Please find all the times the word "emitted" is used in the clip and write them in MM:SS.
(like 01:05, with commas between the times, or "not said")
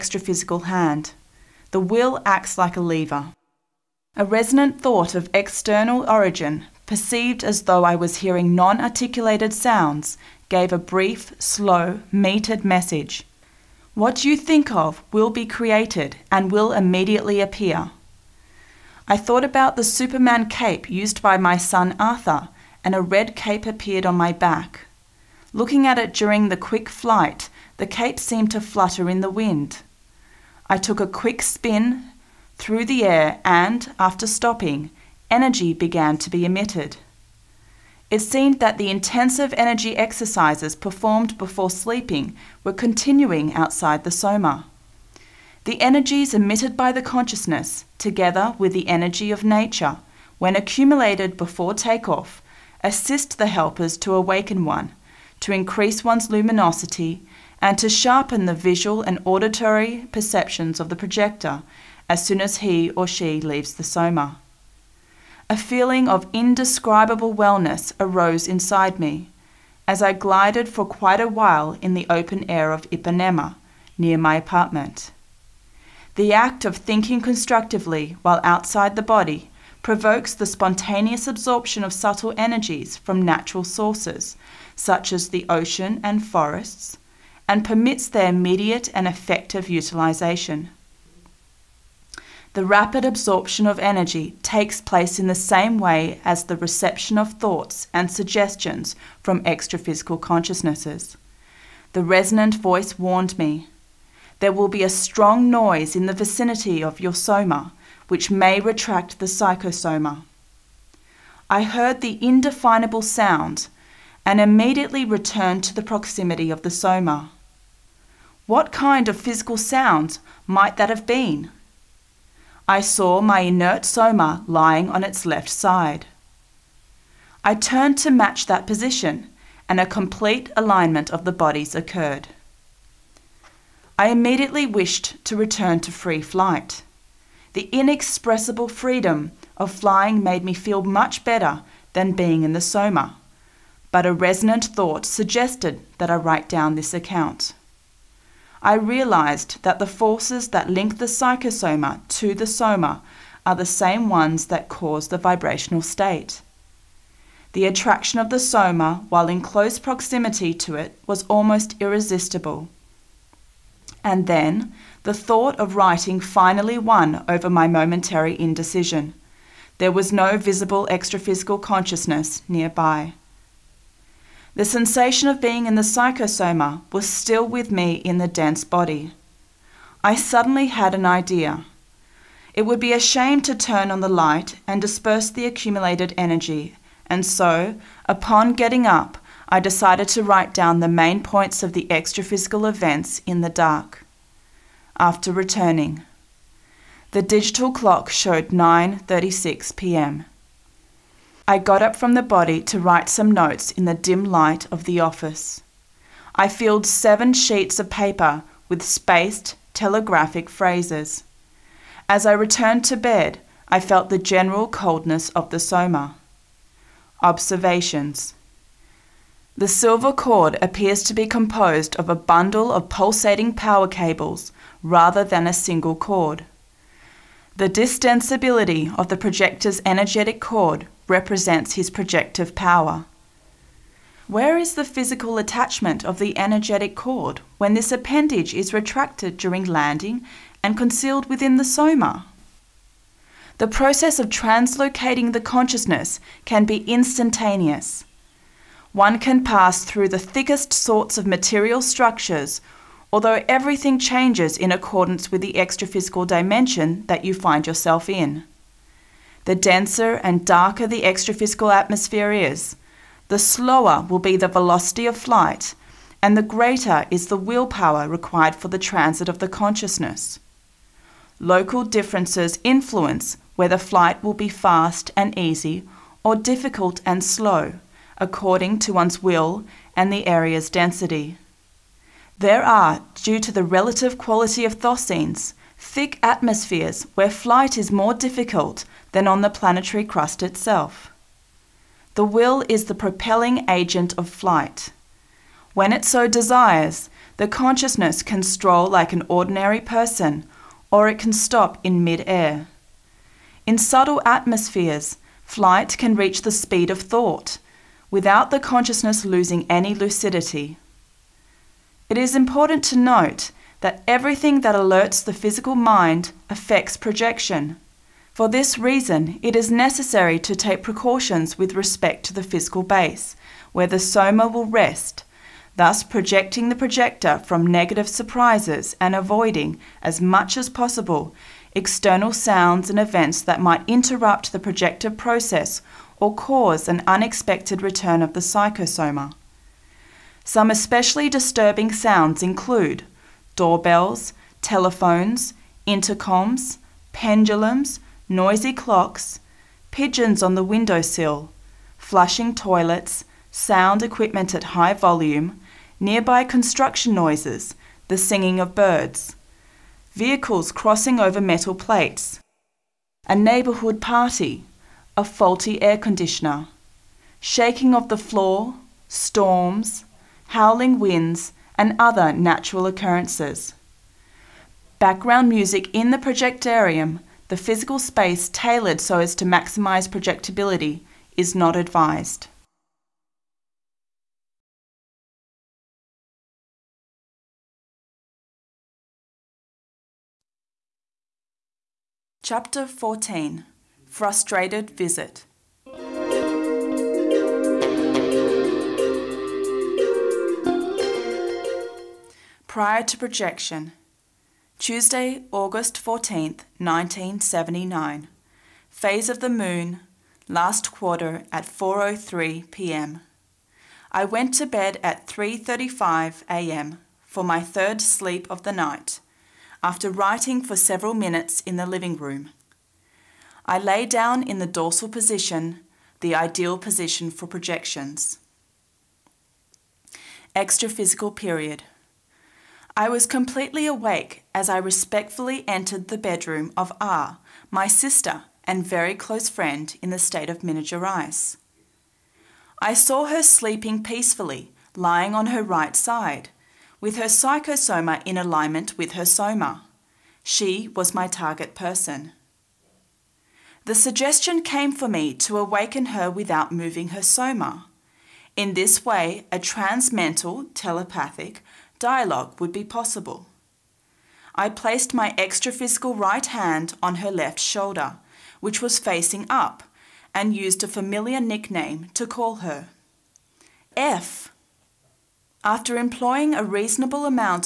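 00:36, 00:46.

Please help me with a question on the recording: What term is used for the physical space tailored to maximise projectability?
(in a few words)
projectarium.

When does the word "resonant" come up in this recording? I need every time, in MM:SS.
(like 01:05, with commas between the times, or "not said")
00:04, 01:42, 02:24.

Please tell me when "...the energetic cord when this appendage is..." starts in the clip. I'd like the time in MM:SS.
03:56.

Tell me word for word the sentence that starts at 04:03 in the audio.
The process of translocating the consciousness can be instantaneous.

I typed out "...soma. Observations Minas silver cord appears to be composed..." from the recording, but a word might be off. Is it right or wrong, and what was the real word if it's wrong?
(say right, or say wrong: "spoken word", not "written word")
wrong: "The", not "Minas".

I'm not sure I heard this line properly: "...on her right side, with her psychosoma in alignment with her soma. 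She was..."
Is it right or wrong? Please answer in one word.
right.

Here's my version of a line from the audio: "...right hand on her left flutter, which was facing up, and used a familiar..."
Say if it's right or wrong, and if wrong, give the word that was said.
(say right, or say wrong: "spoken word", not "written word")
wrong: "shoulder", not "flutter".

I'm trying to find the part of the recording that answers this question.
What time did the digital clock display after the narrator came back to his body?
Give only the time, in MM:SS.
03:18.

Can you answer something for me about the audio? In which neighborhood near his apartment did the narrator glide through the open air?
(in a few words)
Ipanema.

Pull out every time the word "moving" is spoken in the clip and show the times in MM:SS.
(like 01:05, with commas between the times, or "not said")
07:36.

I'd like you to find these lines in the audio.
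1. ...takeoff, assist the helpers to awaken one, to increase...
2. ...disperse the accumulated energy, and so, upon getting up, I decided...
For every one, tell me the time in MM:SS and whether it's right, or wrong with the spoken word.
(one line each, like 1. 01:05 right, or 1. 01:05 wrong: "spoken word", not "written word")
1. 00:51 right
2. 03:04 right.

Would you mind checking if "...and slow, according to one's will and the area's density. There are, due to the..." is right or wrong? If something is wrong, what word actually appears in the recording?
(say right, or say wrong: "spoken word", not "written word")
right.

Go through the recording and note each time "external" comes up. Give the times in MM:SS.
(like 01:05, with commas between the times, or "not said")
00:05, 05:31.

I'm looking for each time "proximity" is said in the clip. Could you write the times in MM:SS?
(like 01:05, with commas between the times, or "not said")
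01:55, 02:39.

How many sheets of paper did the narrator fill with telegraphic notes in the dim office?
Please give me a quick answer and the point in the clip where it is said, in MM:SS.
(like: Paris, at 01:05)
7, at 03:26.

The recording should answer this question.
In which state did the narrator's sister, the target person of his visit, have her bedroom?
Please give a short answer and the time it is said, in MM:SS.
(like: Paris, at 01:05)
Minas, at 07:20.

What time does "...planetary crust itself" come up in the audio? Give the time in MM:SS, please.
04:49.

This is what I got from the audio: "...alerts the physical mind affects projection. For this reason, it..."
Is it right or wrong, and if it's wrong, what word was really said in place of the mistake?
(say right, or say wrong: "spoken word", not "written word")
right.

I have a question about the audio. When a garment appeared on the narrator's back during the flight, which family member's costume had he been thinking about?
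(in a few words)
Arthur.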